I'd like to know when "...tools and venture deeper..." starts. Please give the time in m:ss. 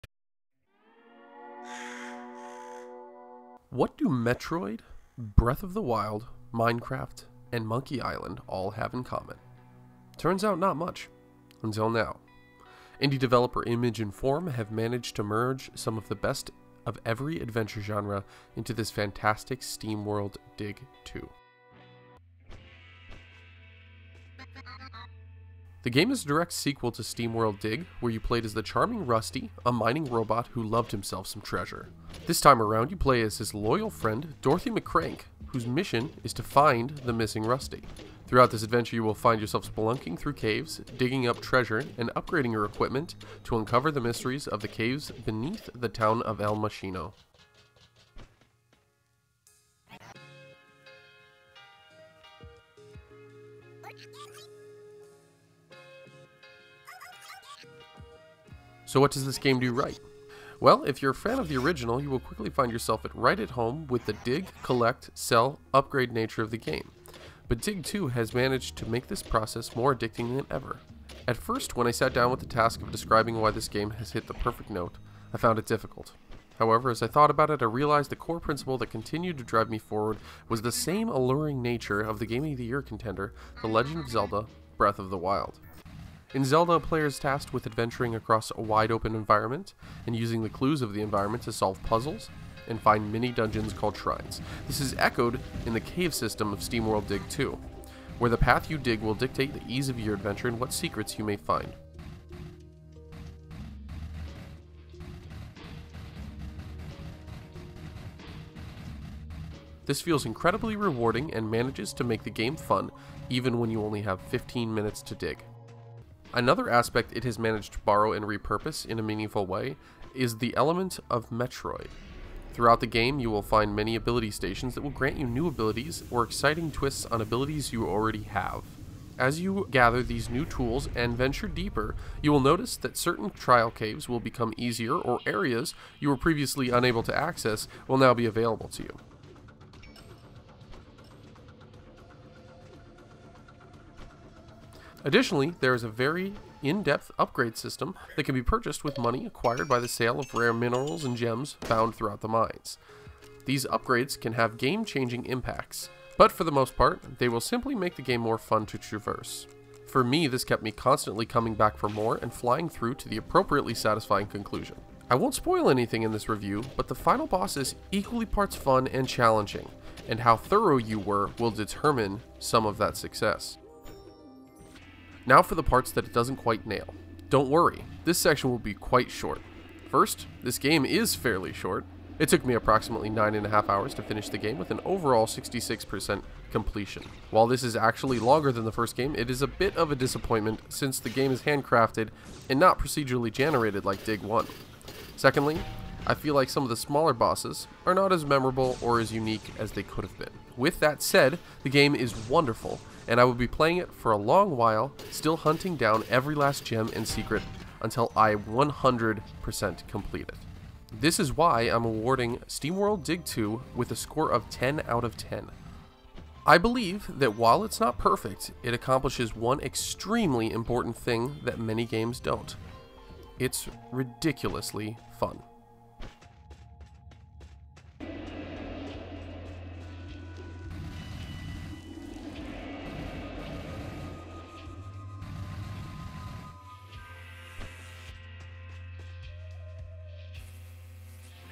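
2:10.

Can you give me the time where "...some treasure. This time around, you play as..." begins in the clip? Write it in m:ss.
0:31.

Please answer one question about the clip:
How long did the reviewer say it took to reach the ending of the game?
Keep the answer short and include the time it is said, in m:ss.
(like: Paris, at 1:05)
9.5 hours, at 3:03.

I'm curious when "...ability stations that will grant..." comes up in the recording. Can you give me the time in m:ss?
2:03.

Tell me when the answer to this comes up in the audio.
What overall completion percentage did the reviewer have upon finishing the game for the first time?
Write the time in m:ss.
3:05.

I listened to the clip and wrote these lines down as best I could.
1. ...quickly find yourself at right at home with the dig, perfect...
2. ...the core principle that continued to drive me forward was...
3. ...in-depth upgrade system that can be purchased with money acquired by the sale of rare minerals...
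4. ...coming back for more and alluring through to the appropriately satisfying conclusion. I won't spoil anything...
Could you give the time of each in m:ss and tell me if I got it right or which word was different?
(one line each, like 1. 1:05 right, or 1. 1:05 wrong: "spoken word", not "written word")
1. 1:02 wrong: "collect", not "perfect"
2. 1:18 right
3. 2:26 right
4. 2:41 wrong: "flying", not "alluring".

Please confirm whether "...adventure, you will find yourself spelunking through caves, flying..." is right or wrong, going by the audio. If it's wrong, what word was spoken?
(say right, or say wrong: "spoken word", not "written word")
wrong: "digging", not "flying".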